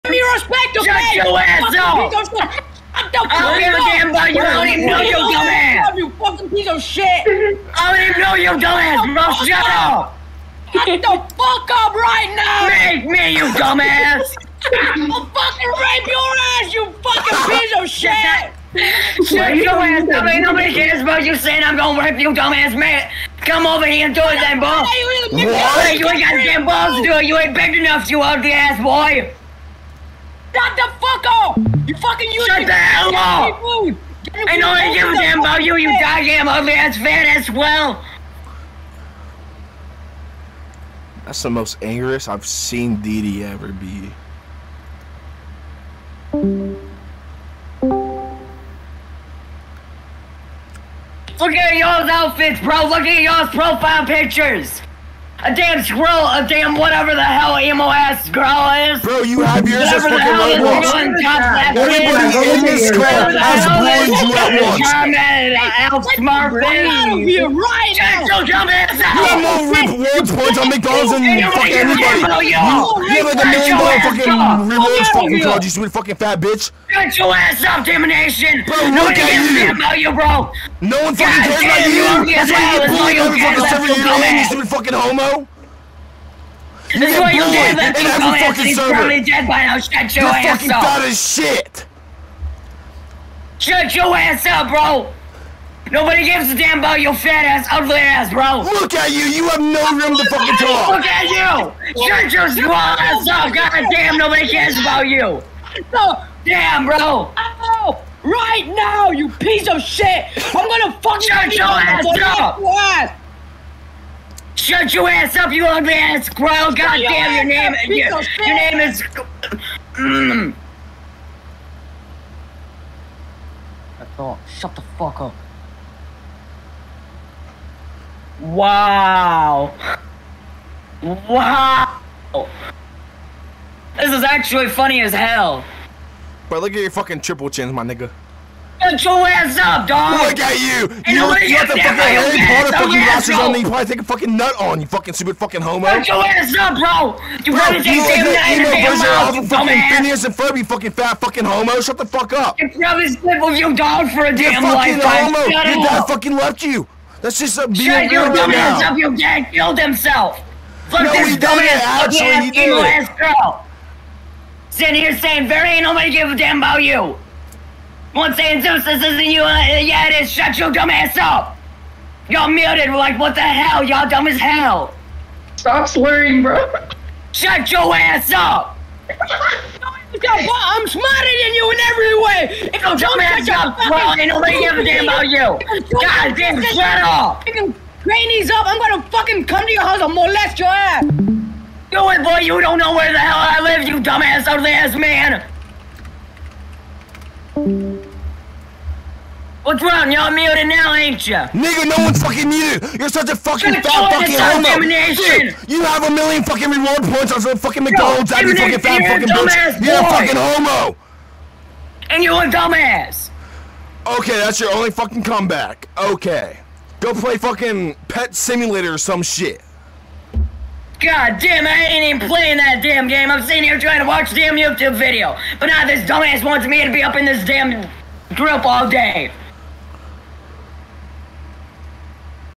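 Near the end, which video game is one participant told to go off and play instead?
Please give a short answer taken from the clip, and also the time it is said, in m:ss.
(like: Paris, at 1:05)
Pet Simulator, at 3:38.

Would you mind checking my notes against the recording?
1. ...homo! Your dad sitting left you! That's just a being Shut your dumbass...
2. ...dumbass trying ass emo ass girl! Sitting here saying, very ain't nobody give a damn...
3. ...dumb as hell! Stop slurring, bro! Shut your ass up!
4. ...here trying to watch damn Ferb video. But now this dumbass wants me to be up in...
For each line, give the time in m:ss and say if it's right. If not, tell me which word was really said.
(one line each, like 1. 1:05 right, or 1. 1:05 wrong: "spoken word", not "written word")
1. 2:35 wrong: "fucking", not "sitting"
2. 2:41 wrong: "fucking", not "trying"
3. 2:54 right
4. 3:43 wrong: "YouTube", not "Ferb".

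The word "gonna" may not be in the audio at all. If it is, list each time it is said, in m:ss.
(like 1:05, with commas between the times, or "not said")
0:21, 1:50, 3:08.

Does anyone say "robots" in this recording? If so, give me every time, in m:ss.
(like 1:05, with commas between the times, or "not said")
1:00.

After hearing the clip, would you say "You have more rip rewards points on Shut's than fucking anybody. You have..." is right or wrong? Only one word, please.
wrong.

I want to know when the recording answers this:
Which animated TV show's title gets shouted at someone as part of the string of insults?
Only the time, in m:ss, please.
2:29.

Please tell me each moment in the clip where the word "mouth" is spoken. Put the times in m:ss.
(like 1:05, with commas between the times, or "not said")
2:28.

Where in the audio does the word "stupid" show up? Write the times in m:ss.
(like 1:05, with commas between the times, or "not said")
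1:24, 2:25.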